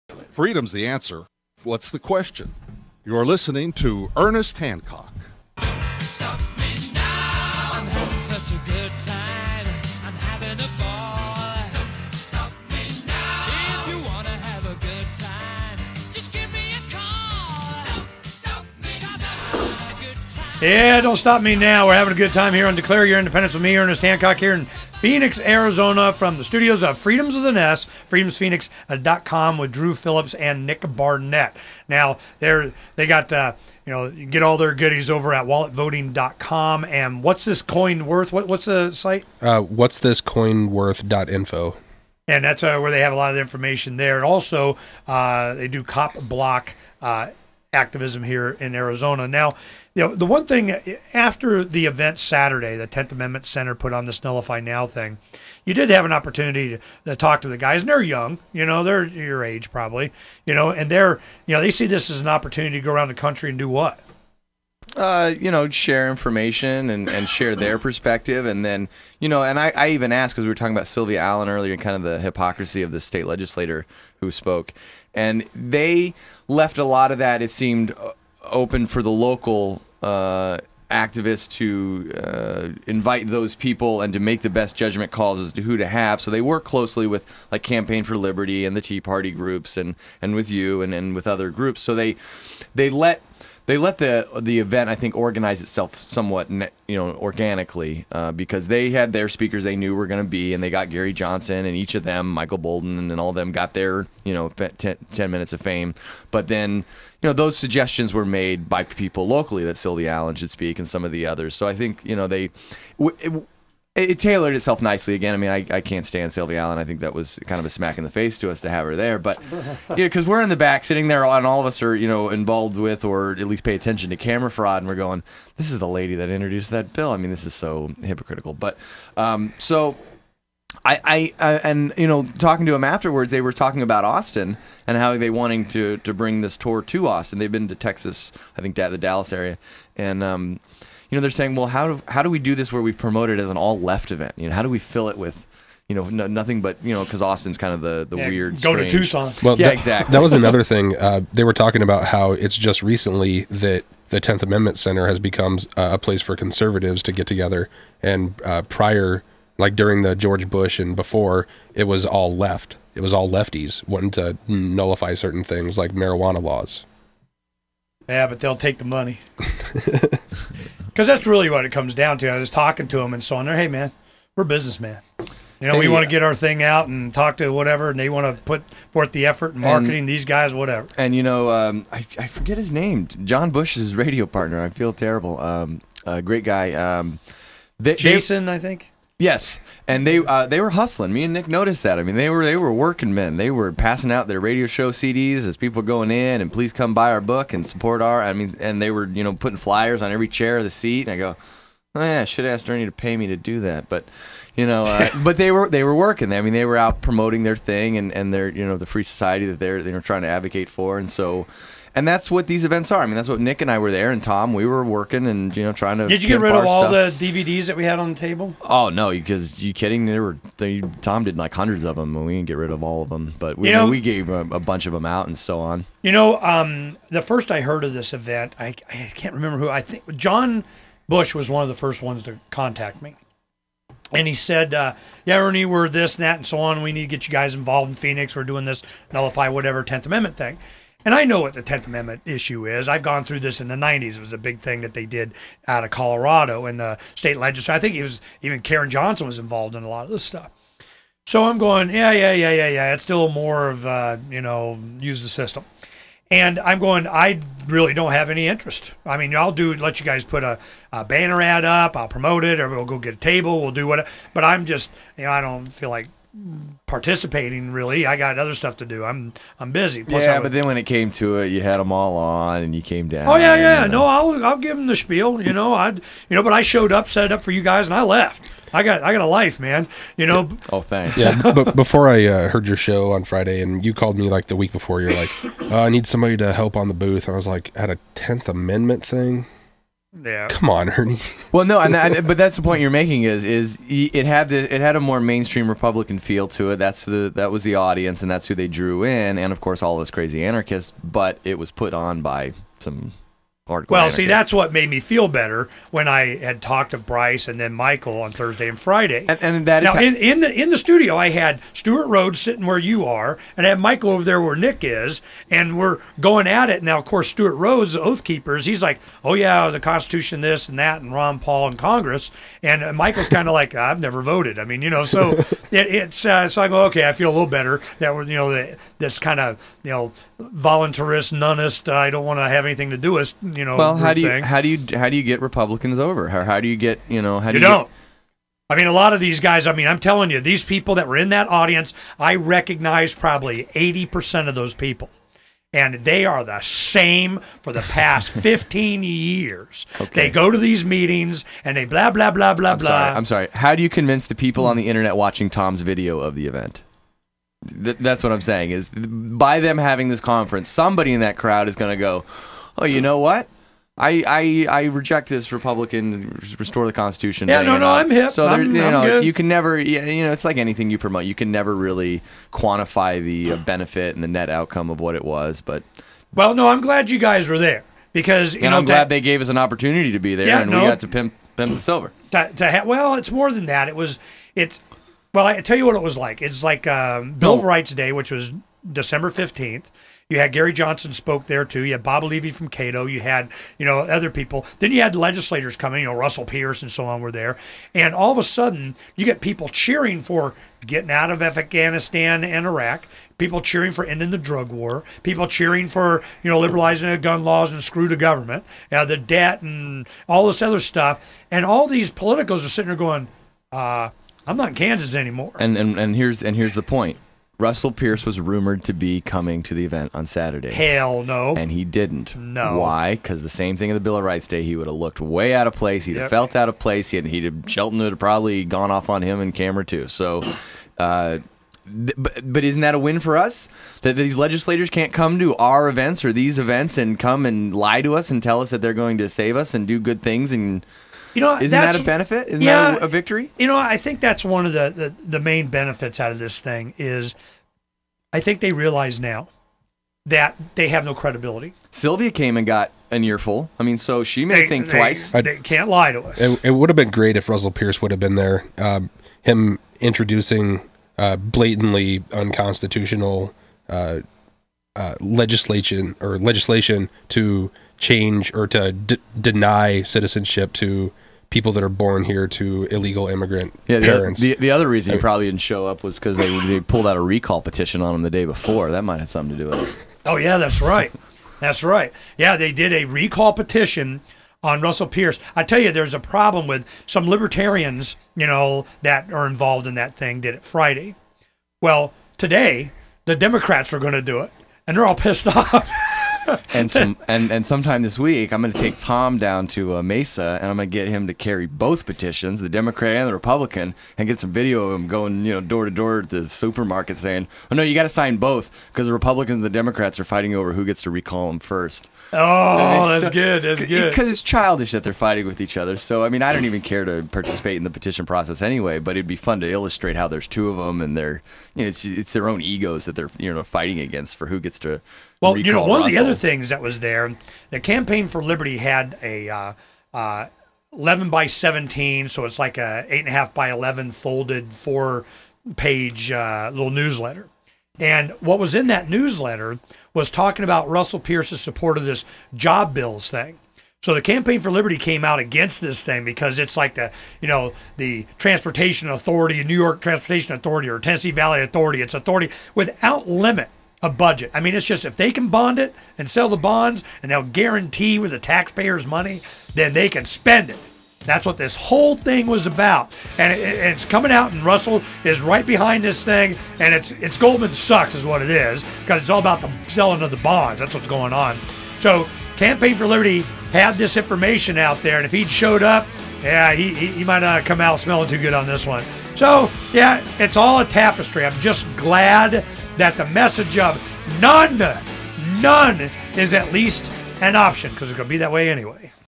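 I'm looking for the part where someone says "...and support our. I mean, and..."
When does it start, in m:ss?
3:17.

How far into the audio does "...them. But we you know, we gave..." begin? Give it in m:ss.
3:43.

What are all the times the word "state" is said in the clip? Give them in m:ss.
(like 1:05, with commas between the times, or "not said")
1:12, 4:07.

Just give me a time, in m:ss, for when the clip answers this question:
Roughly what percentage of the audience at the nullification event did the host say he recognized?
5:43.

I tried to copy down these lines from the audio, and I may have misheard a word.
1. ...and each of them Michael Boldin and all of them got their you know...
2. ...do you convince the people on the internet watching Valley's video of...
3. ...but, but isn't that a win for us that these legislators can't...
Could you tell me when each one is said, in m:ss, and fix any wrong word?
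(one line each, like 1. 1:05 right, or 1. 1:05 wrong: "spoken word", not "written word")
1. 1:41 right
2. 5:53 wrong: "Tom", not "Valley"
3. 7:11 right.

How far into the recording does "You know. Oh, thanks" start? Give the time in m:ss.
4:40.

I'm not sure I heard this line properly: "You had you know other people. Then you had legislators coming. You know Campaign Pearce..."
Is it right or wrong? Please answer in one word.
wrong.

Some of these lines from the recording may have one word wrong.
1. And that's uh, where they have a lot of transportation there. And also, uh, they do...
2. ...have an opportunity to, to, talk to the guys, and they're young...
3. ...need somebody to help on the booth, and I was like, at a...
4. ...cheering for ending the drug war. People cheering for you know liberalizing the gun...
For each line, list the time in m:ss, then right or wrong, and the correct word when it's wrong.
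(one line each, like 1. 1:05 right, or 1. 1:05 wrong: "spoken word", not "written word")
1. 0:42 wrong: "information", not "transportation"
2. 0:55 right
3. 4:45 right
4. 6:43 right.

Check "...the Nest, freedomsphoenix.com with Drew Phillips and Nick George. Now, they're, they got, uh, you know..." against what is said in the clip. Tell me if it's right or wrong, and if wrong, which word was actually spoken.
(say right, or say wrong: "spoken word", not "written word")
wrong: "Barnett", not "George".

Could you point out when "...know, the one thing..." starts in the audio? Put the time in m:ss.
0:50.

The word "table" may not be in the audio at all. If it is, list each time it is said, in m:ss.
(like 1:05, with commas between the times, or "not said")
3:38, 4:23.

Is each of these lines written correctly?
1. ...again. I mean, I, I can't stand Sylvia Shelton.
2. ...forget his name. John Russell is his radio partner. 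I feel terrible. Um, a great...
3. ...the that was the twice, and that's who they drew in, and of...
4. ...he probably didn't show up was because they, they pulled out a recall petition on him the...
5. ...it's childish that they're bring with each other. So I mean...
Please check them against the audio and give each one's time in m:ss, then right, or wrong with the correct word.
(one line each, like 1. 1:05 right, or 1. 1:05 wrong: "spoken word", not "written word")
1. 1:55 wrong: "Allen", not "Shelton"
2. 3:02 wrong: "Bush", not "Russell"
3. 4:57 wrong: "audience", not "twice"
4. 7:55 right
5. 8:34 wrong: "fighting", not "bring".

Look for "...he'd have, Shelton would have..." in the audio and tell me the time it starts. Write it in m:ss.
7:07.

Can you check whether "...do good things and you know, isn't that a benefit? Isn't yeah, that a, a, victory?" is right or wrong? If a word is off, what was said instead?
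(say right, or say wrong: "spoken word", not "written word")
right.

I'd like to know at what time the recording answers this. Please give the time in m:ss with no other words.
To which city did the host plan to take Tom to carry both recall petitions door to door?
8:20.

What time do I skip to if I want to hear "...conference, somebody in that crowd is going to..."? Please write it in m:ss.
6:00.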